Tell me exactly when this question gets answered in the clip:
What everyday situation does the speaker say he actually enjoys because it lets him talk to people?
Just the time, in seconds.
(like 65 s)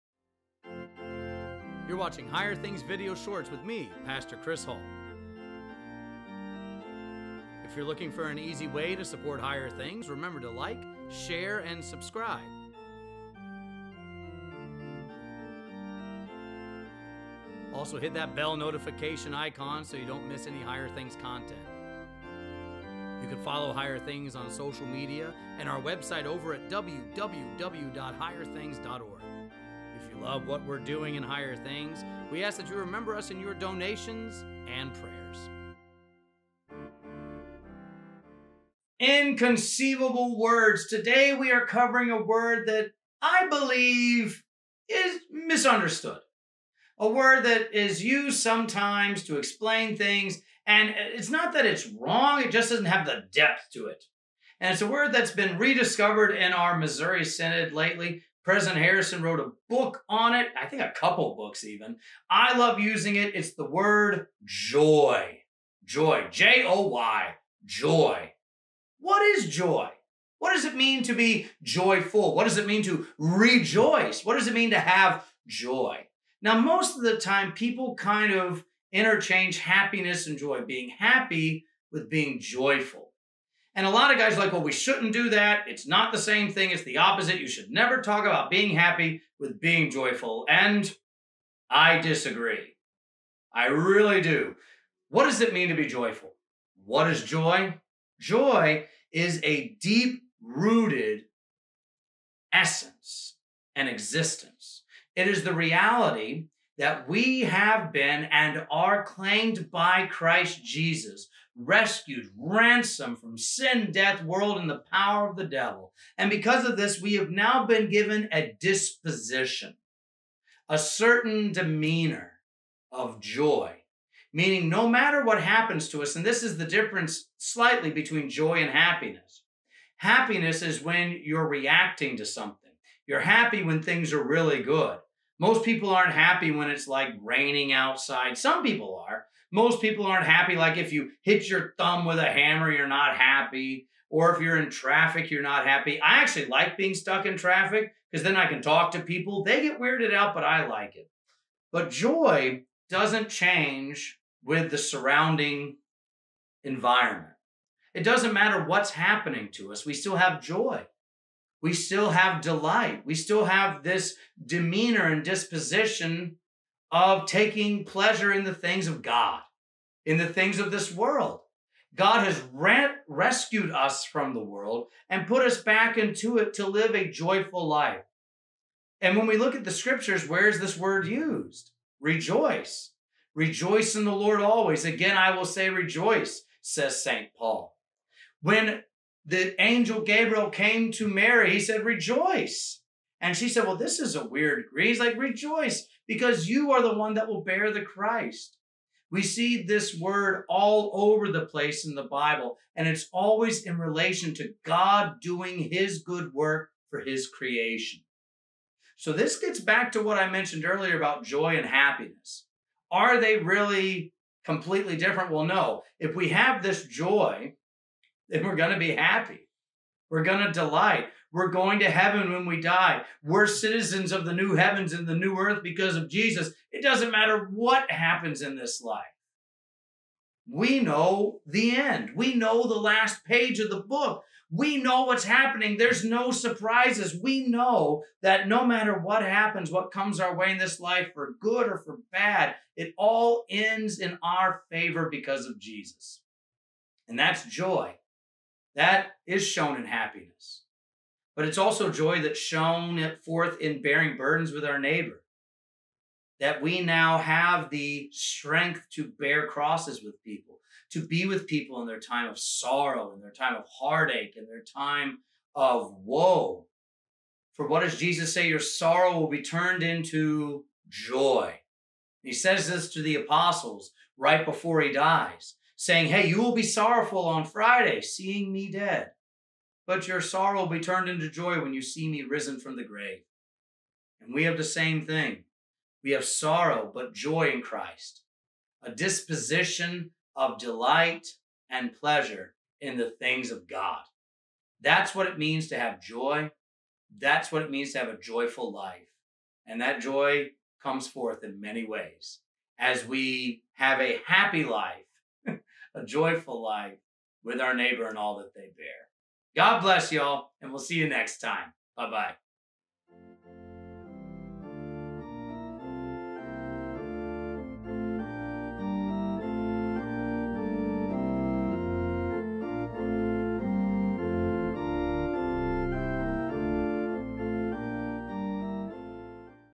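146 s.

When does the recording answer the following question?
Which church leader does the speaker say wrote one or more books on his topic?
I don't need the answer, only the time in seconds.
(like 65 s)
58 s.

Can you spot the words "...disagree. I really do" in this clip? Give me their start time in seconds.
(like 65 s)
91 s.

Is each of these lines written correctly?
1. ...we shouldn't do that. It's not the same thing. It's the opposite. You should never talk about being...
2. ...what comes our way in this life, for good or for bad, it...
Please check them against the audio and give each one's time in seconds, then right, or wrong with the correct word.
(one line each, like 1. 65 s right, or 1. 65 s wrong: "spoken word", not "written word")
1. 84 s right
2. 239 s right.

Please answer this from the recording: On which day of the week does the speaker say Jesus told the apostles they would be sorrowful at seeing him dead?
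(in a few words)
Friday.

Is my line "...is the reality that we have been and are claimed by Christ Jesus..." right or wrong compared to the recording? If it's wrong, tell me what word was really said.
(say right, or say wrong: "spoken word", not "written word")
right.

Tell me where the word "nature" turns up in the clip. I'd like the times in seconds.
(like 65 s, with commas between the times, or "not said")
not said.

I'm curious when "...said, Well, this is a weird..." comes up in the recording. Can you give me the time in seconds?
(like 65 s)
193 s.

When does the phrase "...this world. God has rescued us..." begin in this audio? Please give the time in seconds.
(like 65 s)
170 s.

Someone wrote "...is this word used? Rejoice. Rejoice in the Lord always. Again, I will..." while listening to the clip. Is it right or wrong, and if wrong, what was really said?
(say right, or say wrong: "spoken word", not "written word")
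right.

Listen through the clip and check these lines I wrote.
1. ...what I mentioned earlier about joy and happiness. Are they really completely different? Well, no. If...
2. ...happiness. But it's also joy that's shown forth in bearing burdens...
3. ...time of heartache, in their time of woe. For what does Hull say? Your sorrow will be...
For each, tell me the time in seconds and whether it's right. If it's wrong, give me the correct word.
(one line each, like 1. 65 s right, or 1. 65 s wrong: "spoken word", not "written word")
1. 210 s right
2. 249 s right
3. 263 s wrong: "Jesus", not "Hull".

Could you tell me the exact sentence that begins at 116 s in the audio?
And because of this, we have now been given a disposition, a certain demeanor of joy.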